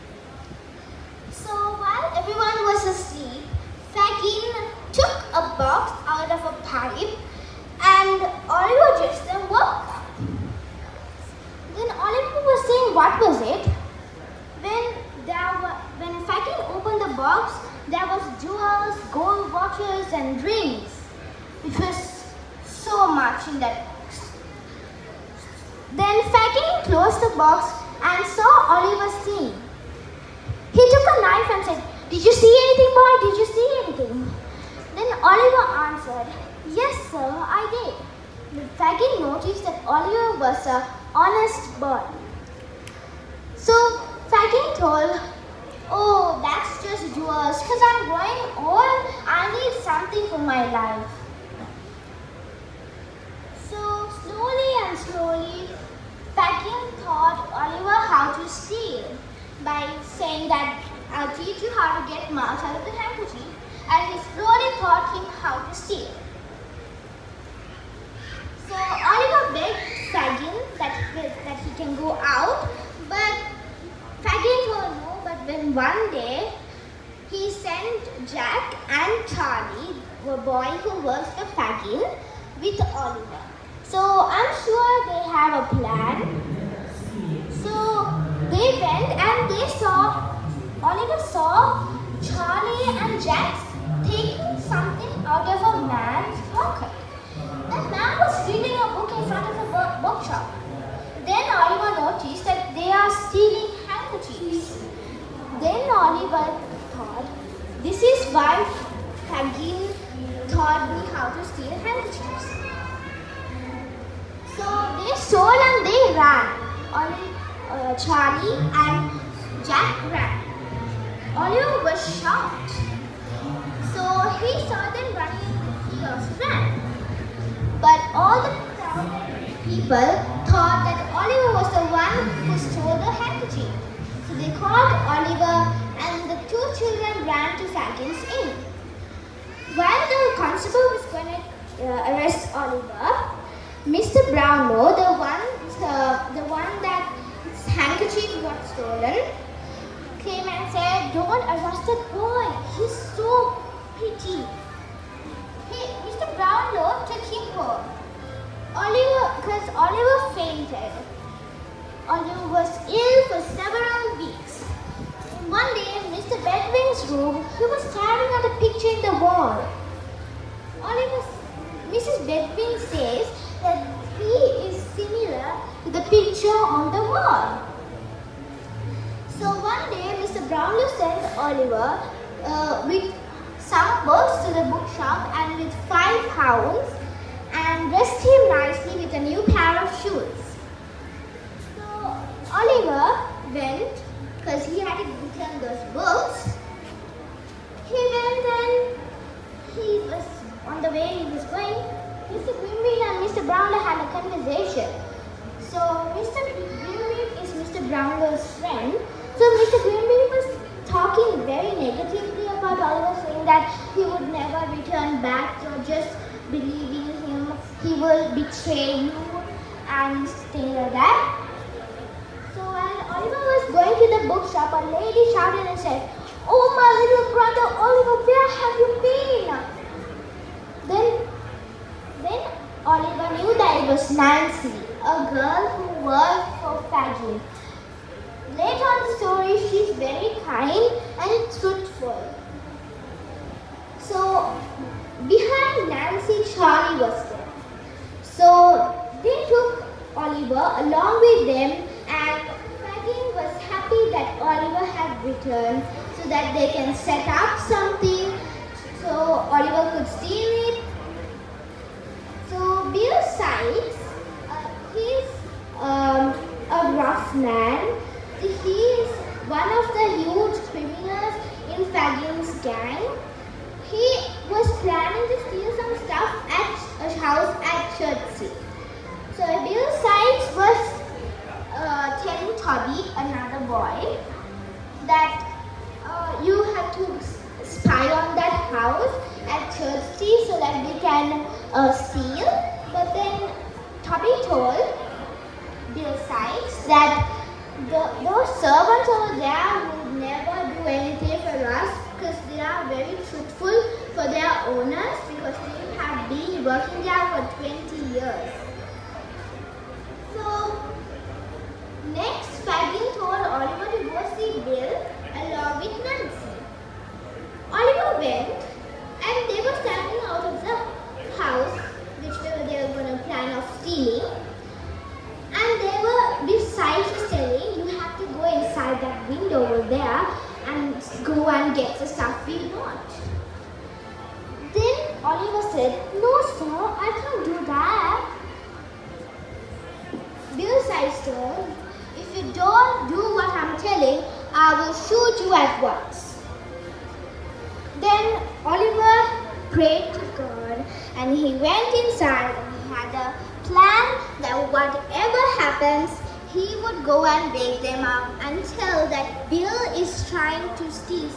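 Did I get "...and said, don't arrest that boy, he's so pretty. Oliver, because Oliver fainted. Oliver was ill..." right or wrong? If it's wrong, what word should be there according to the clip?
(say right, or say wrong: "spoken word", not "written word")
right.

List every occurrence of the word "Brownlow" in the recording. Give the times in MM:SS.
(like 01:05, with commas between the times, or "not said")
02:24, 03:00, 03:23, 03:27.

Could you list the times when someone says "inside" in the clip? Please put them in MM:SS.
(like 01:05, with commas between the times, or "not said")
05:28, 05:52.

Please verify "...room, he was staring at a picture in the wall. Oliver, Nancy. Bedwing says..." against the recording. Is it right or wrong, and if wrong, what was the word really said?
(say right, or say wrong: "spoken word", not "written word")
wrong: "Mrs", not "Nancy".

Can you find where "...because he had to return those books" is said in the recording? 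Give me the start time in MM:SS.
03:14.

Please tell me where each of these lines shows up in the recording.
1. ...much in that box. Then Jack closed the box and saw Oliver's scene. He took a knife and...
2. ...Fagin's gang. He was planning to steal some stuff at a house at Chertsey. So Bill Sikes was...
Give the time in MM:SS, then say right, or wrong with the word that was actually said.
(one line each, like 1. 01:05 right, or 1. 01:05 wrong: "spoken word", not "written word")
1. 00:23 wrong: "Fagin", not "Jack"
2. 04:31 right.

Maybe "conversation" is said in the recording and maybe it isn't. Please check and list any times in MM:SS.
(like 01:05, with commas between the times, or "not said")
03:24.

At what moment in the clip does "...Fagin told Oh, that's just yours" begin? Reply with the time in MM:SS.
00:44.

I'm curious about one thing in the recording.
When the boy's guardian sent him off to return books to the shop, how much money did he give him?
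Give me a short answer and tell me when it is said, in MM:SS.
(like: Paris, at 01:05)
5 pounds, at 03:05.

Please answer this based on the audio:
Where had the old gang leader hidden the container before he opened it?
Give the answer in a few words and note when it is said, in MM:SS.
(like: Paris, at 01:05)
A pipe, at 00:06.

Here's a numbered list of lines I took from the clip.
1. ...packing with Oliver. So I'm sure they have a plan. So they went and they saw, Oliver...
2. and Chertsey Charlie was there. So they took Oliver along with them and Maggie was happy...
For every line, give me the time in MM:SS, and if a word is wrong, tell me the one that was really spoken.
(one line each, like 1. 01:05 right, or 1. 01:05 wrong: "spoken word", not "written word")
1. 01:21 right
2. 04:05 wrong: "Nancy", not "Chertsey".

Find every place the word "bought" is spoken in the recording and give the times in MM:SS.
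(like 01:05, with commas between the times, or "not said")
not said.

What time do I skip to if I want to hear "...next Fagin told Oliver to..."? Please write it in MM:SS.
05:12.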